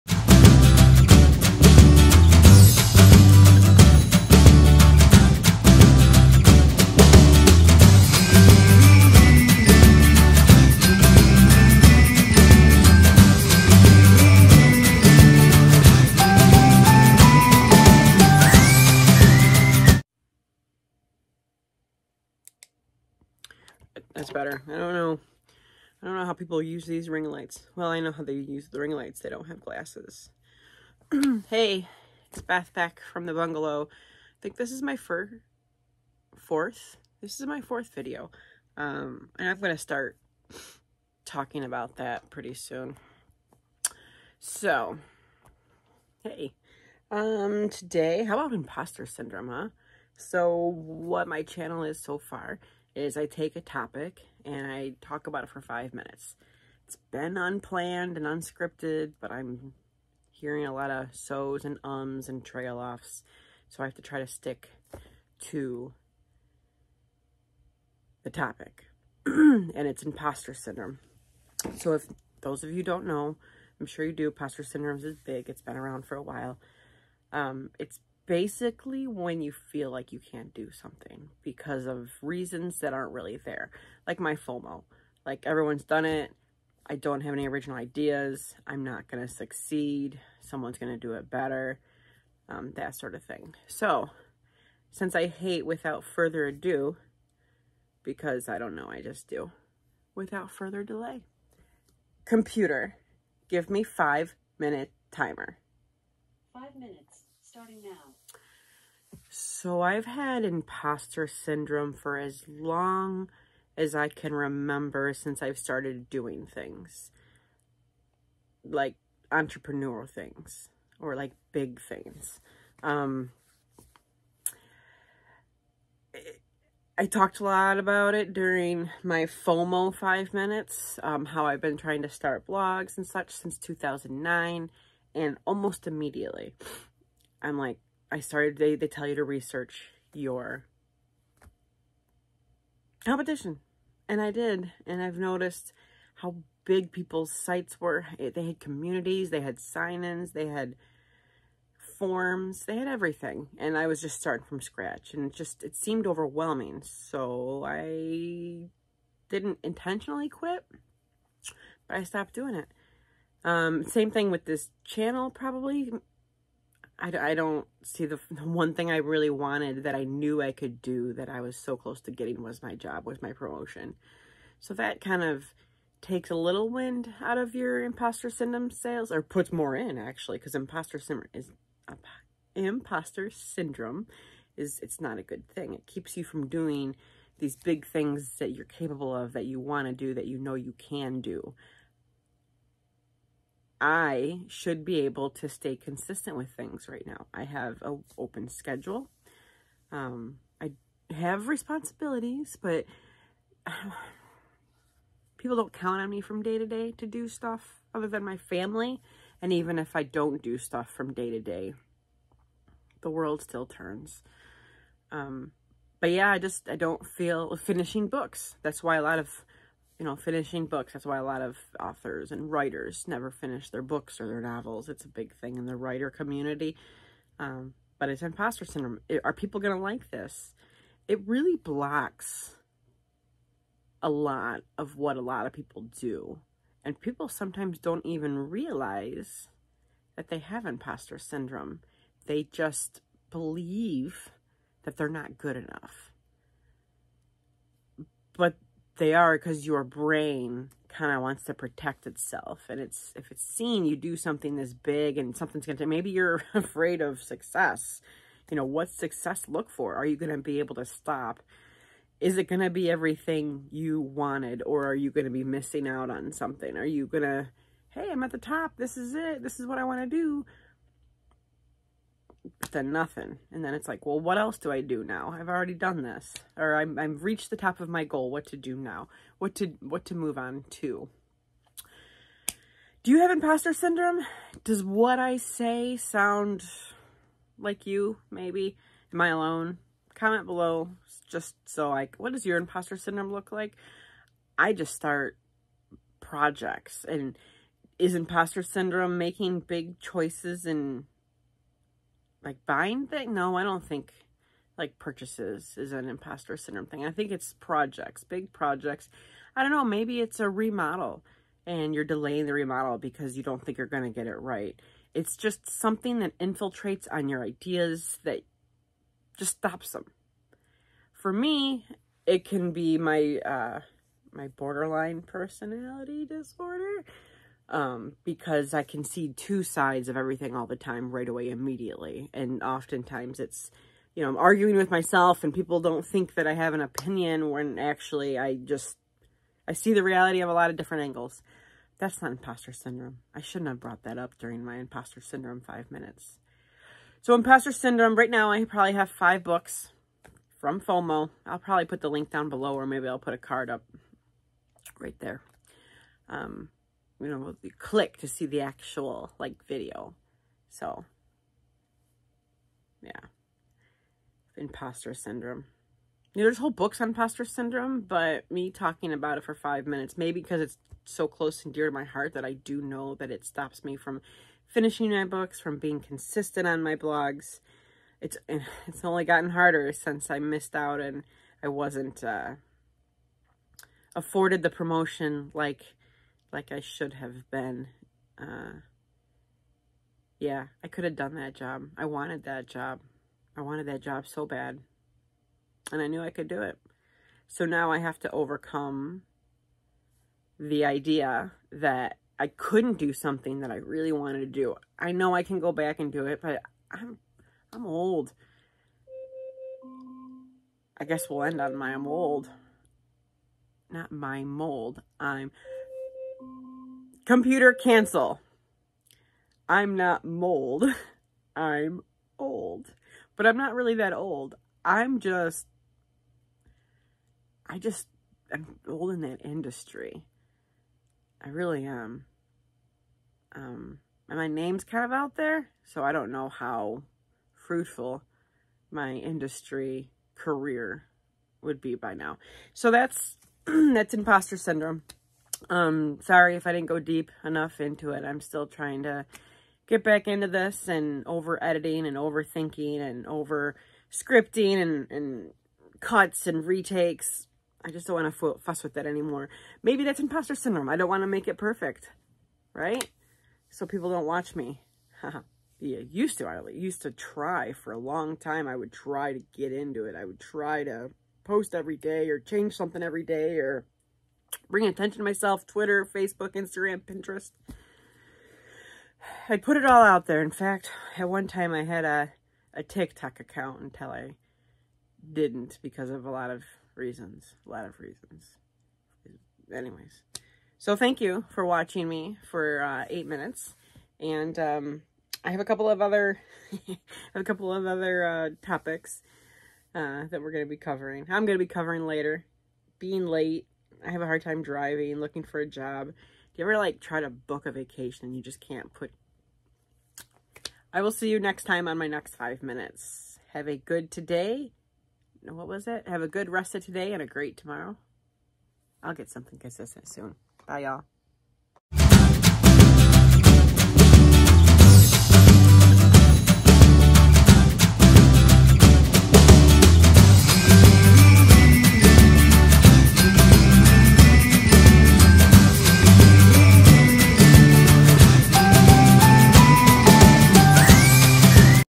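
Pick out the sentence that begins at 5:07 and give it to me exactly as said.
I think it's projects, big projects.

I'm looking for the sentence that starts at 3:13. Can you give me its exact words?
I should be able to stay consistent with things right now.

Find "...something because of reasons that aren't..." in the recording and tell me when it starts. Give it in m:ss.
1:20.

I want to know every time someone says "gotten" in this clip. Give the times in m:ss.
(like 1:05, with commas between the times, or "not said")
6:19.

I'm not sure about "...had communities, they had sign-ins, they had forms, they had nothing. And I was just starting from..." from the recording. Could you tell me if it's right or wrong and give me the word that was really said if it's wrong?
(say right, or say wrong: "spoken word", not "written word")
wrong: "everything", not "nothing".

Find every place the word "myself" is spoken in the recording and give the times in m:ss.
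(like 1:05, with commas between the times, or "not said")
5:34, 7:55.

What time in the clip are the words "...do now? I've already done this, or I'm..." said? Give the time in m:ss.
4:34.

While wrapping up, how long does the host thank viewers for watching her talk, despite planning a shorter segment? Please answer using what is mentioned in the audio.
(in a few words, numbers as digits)
8 minutes.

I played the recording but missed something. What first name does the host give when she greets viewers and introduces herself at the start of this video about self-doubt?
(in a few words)
Beth.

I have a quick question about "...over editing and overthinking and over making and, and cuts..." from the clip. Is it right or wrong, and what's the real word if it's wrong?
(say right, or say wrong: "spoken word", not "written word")
wrong: "scripting", not "making".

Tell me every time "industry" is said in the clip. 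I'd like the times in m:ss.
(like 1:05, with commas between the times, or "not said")
7:09, 7:19.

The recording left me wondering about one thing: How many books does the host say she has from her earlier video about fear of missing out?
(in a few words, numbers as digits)
5 books.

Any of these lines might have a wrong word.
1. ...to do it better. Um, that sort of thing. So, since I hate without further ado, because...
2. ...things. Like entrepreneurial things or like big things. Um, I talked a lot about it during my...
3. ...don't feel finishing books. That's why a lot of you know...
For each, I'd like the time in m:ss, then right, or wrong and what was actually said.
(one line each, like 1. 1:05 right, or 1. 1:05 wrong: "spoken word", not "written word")
1. 1:30 right
2. 1:56 right
3. 3:36 right.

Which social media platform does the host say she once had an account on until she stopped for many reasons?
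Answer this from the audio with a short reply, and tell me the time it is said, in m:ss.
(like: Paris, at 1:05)
TikTok, at 8:02.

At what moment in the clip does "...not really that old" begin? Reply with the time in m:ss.
7:03.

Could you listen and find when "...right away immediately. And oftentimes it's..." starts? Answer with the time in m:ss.
5:31.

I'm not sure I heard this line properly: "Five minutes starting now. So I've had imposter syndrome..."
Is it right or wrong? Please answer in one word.
right.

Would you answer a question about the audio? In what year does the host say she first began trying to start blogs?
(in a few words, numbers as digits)
2009.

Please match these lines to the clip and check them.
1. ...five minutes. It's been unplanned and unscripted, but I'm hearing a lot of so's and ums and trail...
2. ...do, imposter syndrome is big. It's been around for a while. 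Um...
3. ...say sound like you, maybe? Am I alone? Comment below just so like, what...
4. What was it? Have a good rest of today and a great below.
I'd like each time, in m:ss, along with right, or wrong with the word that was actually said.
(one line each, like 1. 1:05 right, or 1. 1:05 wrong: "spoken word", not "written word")
1. 0:55 right
2. 1:14 right
3. 4:45 right
4. 8:35 wrong: "tomorrow", not "below".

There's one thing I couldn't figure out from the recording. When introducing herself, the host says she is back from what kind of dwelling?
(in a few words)
the bungalow.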